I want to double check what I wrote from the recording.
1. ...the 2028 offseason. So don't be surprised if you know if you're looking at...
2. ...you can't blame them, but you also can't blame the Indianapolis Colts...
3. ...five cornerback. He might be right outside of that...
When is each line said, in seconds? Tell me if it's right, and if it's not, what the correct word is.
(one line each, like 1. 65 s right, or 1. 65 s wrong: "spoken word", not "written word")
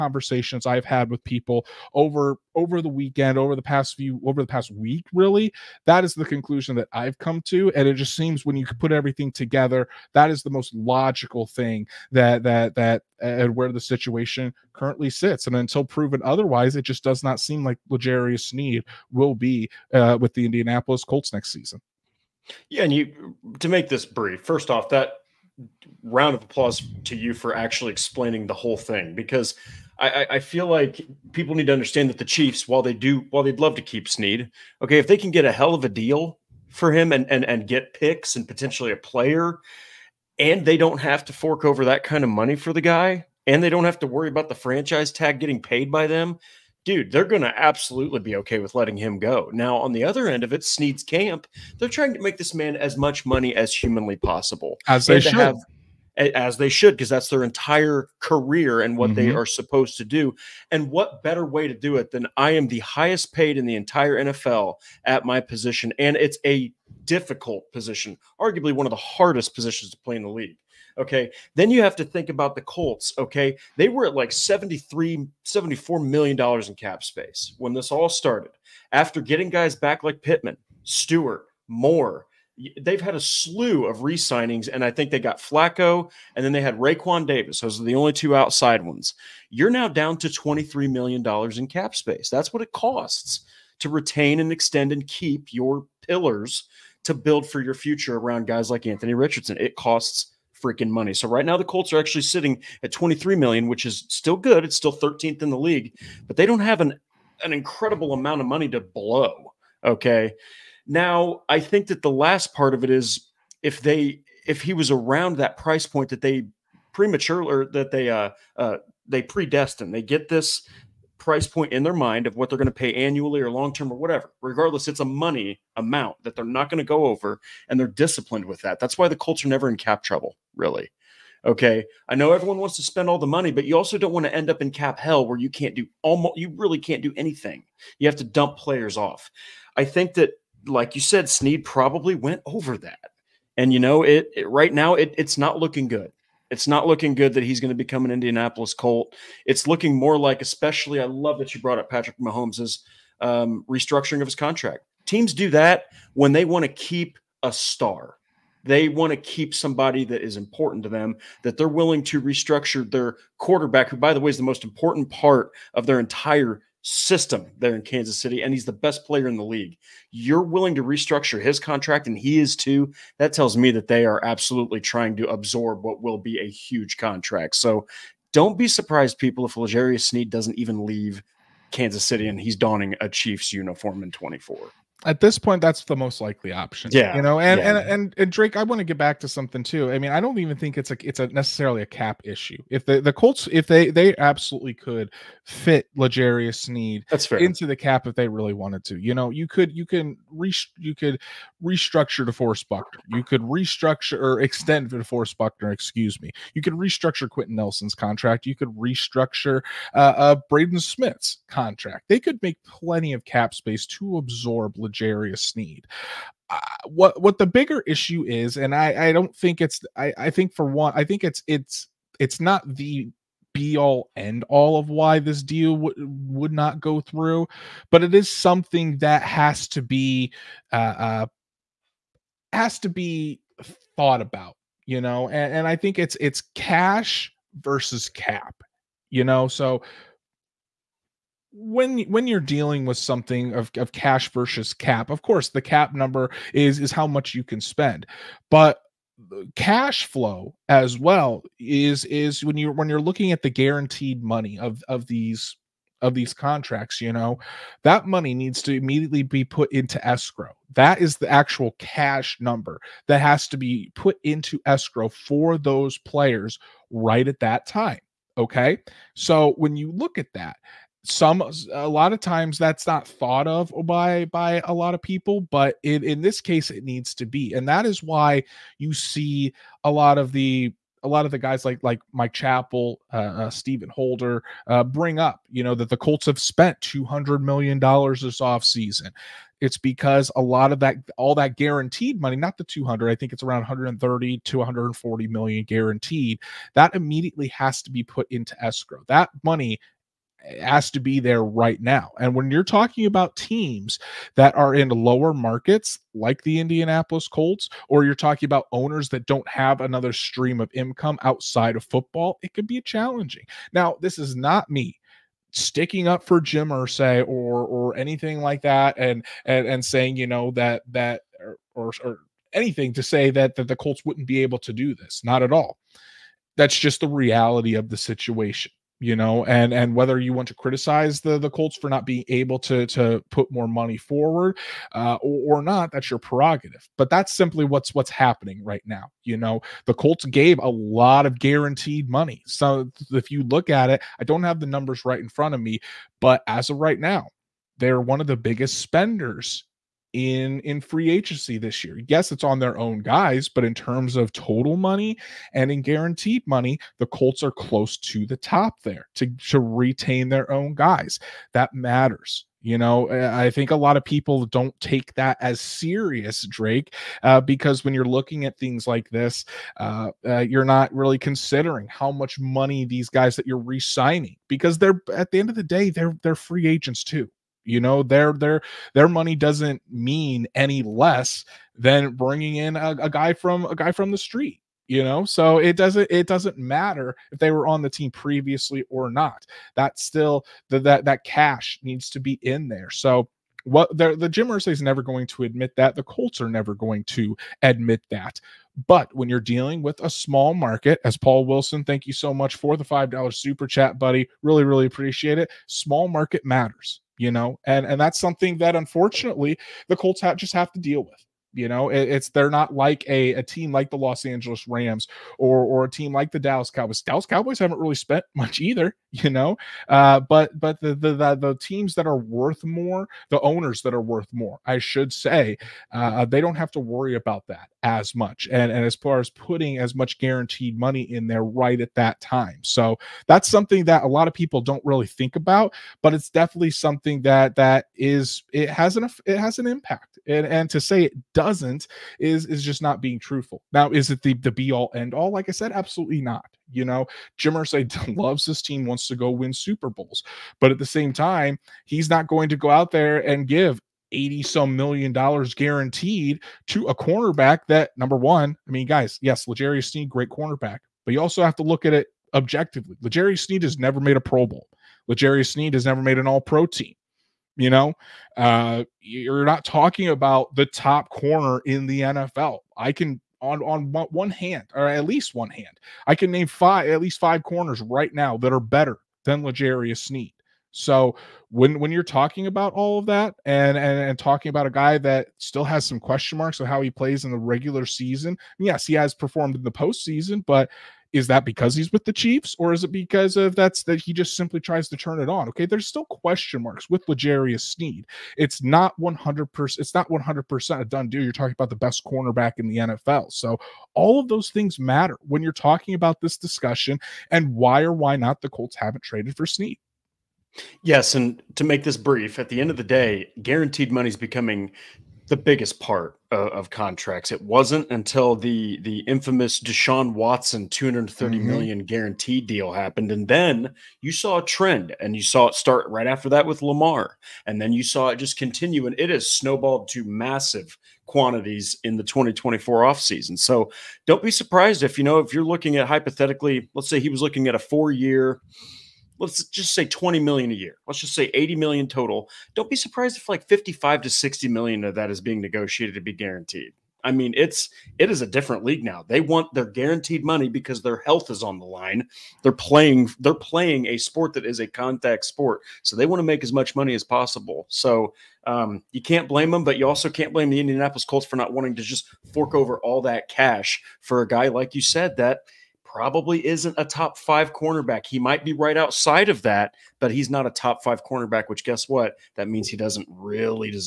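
1. 531 s wrong: "2024", not "2028"
2. 558 s right
3. 567 s right.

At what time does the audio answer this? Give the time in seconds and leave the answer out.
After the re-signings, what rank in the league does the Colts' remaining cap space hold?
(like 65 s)
104 s.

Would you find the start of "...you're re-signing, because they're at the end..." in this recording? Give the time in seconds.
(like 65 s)
373 s.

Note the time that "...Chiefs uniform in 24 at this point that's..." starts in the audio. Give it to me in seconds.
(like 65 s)
183 s.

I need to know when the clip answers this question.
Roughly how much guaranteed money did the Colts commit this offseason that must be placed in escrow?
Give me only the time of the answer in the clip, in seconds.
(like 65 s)
293 s.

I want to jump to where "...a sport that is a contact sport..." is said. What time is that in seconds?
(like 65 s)
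553 s.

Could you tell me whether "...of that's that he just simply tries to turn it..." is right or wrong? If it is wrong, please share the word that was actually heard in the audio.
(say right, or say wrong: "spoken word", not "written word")
right.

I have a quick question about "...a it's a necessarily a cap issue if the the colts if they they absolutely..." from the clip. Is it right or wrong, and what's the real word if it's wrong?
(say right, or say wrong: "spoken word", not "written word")
right.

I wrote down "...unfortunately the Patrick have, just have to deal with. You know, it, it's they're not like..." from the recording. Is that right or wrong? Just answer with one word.
wrong.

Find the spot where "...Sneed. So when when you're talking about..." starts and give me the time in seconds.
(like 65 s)
479 s.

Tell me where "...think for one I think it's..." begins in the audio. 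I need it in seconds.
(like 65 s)
220 s.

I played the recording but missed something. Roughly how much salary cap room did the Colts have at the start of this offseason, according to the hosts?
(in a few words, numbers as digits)
73, 74 million dollars.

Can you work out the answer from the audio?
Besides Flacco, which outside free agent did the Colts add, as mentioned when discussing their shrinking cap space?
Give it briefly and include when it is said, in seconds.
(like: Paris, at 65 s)
Raekwon Davis, at 86 s.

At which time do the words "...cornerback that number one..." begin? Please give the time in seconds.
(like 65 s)
456 s.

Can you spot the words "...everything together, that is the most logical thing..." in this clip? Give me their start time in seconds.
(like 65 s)
8 s.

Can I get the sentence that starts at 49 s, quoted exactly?
Now, on the other end of it, Sneed's camp, they're trying to make this man as much money as humanly possible.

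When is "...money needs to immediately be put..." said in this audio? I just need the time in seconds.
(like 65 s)
258 s.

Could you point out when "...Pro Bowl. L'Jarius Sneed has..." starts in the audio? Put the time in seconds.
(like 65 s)
464 s.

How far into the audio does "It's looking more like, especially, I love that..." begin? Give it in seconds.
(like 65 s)
149 s.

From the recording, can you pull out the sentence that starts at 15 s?
And until proven otherwise, it just does not seem like L'Jarius Sneed will be uh, with the Indianapolis Colts next season.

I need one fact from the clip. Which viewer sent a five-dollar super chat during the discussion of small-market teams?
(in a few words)
Paul Wilson.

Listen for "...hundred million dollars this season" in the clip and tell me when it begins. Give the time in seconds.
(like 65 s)
287 s.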